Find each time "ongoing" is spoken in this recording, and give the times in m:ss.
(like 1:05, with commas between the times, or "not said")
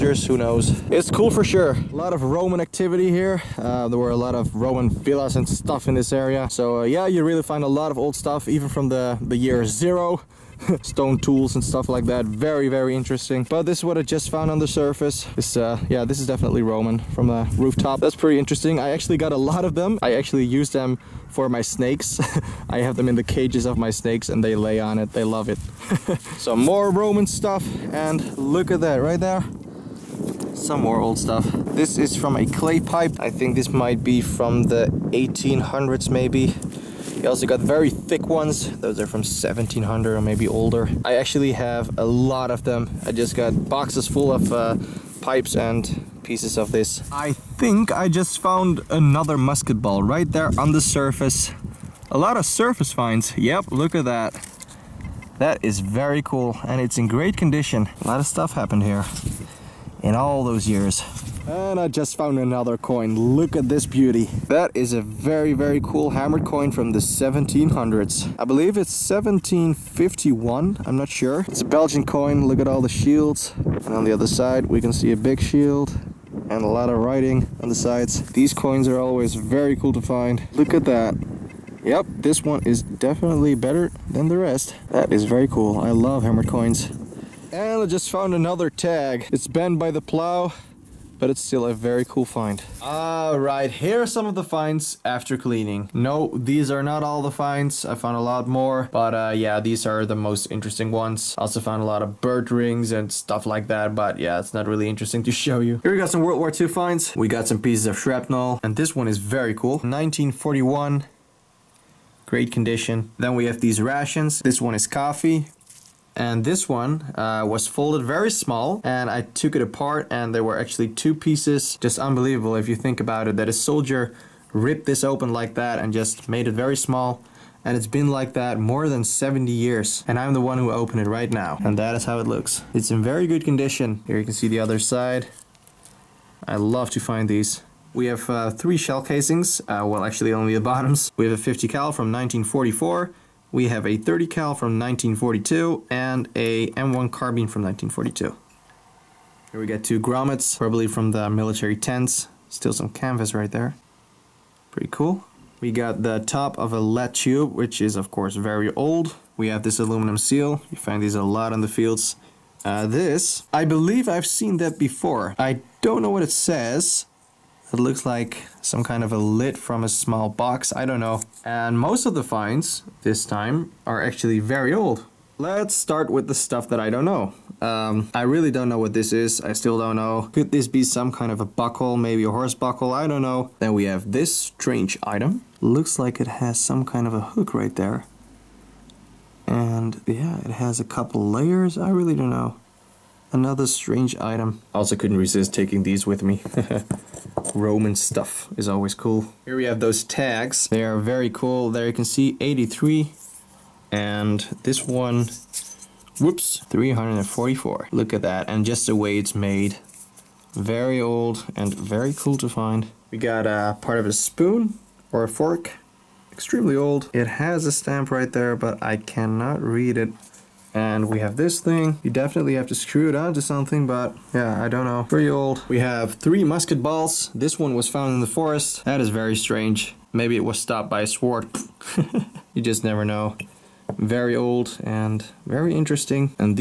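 not said.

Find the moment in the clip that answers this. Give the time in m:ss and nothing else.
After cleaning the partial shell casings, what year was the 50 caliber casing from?
2:22.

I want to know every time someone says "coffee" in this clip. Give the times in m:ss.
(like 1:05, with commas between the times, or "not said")
1:54.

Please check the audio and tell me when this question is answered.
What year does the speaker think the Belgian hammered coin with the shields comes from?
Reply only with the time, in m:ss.
1:09.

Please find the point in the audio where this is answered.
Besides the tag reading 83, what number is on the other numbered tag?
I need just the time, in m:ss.
3:26.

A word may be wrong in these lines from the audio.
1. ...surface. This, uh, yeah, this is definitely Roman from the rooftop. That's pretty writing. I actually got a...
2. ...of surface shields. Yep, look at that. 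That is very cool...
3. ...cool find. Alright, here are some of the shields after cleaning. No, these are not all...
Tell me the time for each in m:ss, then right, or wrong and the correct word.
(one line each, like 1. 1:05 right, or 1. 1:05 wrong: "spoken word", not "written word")
1. 0:14 wrong: "interesting", not "writing"
2. 0:52 wrong: "finds", not "shields"
3. 1:32 wrong: "finds", not "shields".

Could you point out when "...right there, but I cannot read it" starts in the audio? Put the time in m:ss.
3:38.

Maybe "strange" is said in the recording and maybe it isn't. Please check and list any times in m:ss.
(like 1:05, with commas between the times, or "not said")
3:04, 3:13, 3:49.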